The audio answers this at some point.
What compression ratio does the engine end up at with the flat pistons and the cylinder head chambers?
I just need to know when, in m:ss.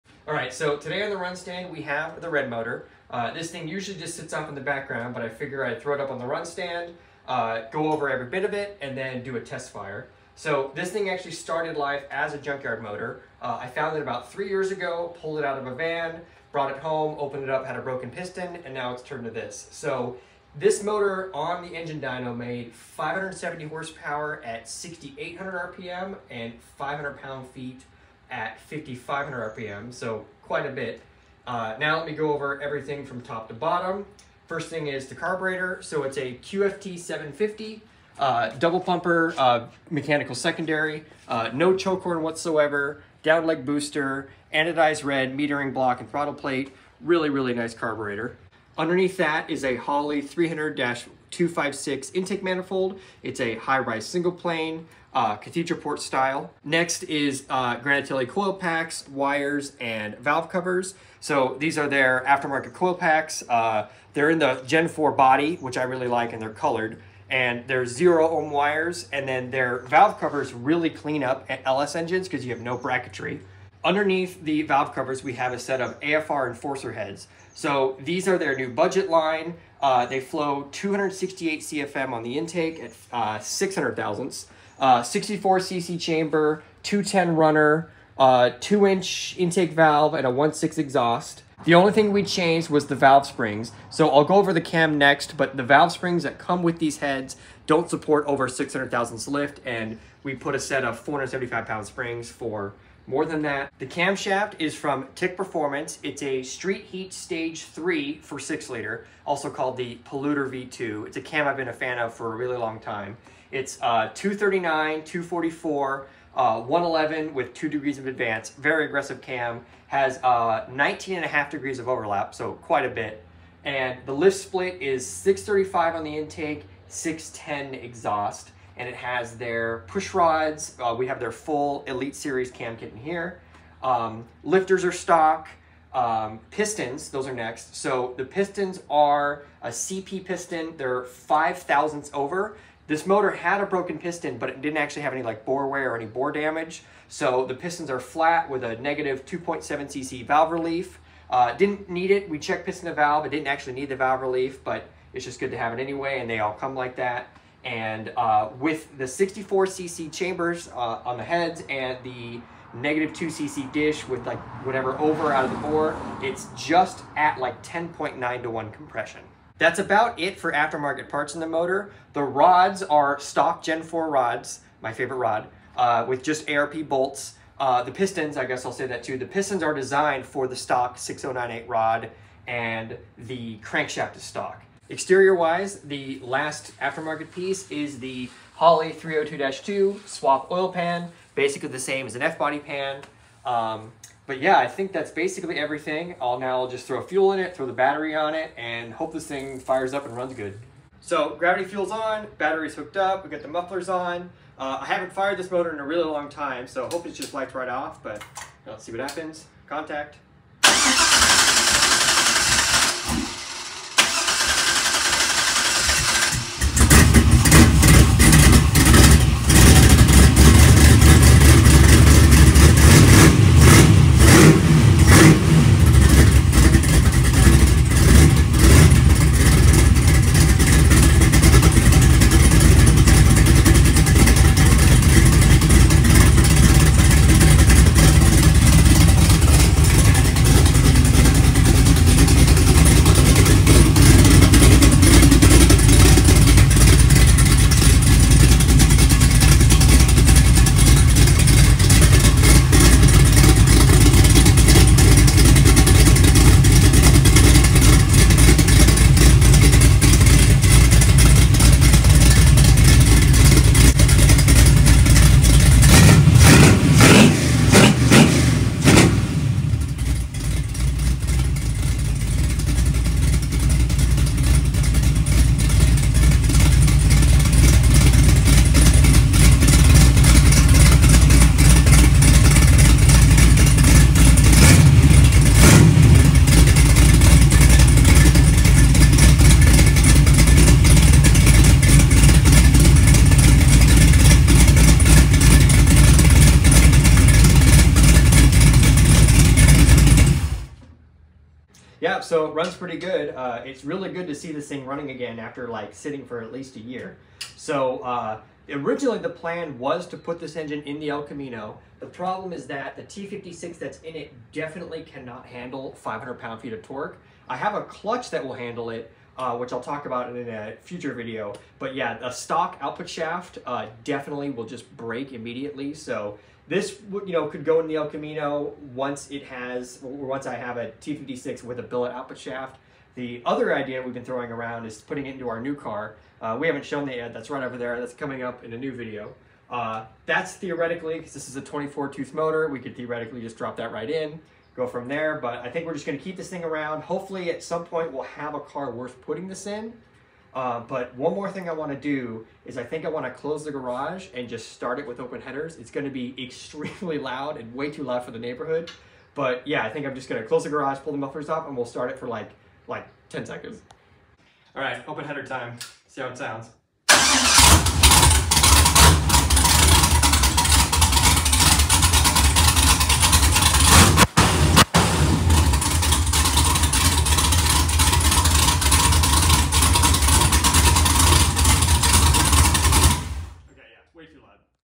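2:47.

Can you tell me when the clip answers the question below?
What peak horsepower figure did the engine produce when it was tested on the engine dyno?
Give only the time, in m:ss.
0:22.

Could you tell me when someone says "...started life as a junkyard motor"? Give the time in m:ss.
0:11.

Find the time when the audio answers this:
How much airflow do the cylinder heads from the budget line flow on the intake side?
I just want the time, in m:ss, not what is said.
1:20.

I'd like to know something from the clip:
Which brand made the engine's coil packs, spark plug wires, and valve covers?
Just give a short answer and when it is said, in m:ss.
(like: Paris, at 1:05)
Granatelli, at 0:57.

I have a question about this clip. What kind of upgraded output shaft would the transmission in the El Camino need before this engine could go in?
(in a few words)
billet output shaft.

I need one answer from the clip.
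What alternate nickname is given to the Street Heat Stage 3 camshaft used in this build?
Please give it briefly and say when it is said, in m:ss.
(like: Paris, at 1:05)
Polluter V2, at 1:50.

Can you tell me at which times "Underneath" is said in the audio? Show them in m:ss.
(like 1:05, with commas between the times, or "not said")
0:48, 1:13.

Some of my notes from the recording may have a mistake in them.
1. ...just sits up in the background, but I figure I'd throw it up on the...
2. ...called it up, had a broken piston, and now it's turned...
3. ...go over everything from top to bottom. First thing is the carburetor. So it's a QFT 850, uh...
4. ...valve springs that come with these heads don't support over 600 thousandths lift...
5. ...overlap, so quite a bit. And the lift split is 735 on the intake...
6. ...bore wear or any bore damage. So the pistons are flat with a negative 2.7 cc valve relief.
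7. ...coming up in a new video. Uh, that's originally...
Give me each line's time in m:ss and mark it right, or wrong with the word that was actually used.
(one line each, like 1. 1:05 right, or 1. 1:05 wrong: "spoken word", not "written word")
1. 0:03 right
2. 0:17 wrong: "opened", not "called"
3. 0:32 wrong: "750", not "850"
4. 1:35 right
5. 2:01 wrong: "635", not "735"
6. 2:25 right
7. 5:38 wrong: "theoretically", not "originally".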